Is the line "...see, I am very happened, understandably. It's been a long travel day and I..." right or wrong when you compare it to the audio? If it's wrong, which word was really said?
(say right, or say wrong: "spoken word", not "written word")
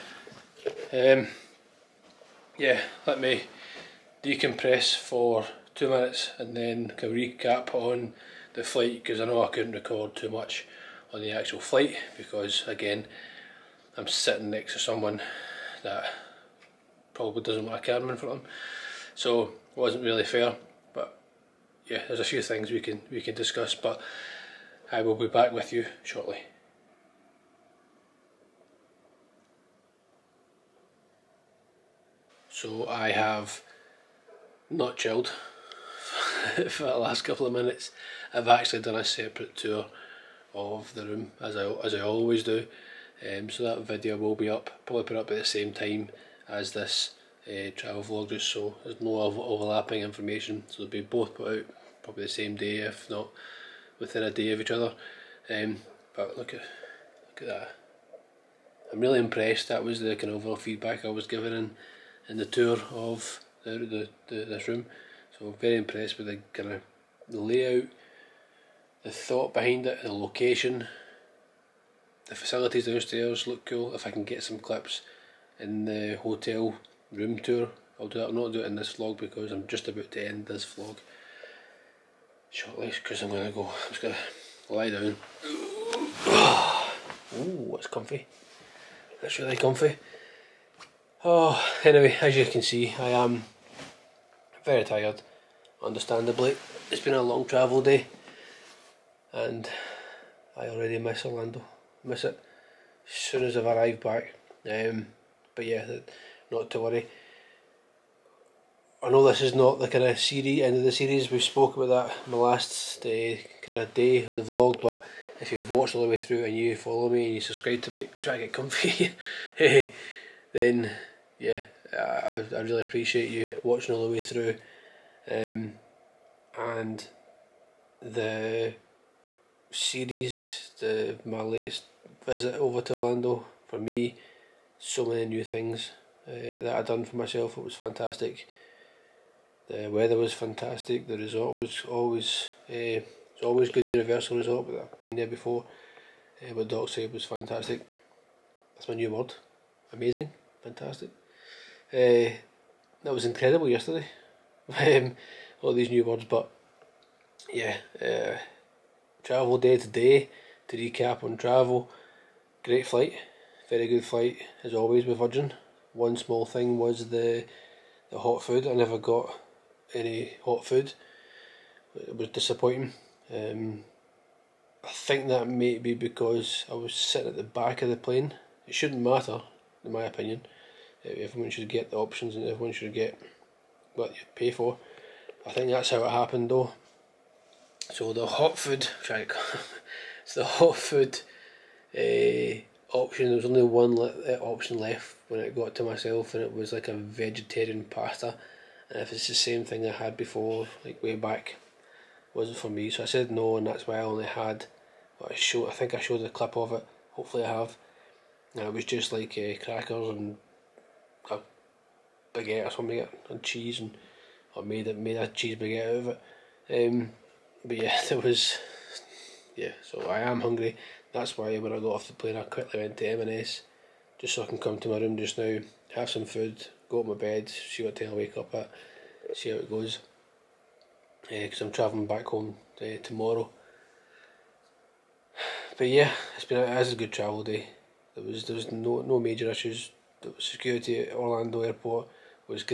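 wrong: "tired", not "happened".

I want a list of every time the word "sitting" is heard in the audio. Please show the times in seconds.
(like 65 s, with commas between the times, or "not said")
14 s, 176 s.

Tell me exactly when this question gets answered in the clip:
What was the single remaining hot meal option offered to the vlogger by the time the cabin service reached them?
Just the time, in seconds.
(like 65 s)
196 s.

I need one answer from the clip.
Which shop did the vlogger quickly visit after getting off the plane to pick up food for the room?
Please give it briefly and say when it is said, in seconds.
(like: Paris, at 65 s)
M&S, at 223 s.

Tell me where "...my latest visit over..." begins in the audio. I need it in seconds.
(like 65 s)
131 s.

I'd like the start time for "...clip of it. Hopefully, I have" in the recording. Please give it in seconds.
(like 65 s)
206 s.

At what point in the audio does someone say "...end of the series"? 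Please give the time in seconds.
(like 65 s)
110 s.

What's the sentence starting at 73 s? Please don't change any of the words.
If I can get some clips in the hotel room tour, I'll do that.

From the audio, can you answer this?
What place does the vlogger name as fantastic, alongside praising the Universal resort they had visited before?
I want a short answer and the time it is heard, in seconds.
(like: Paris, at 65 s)
Dockside, at 146 s.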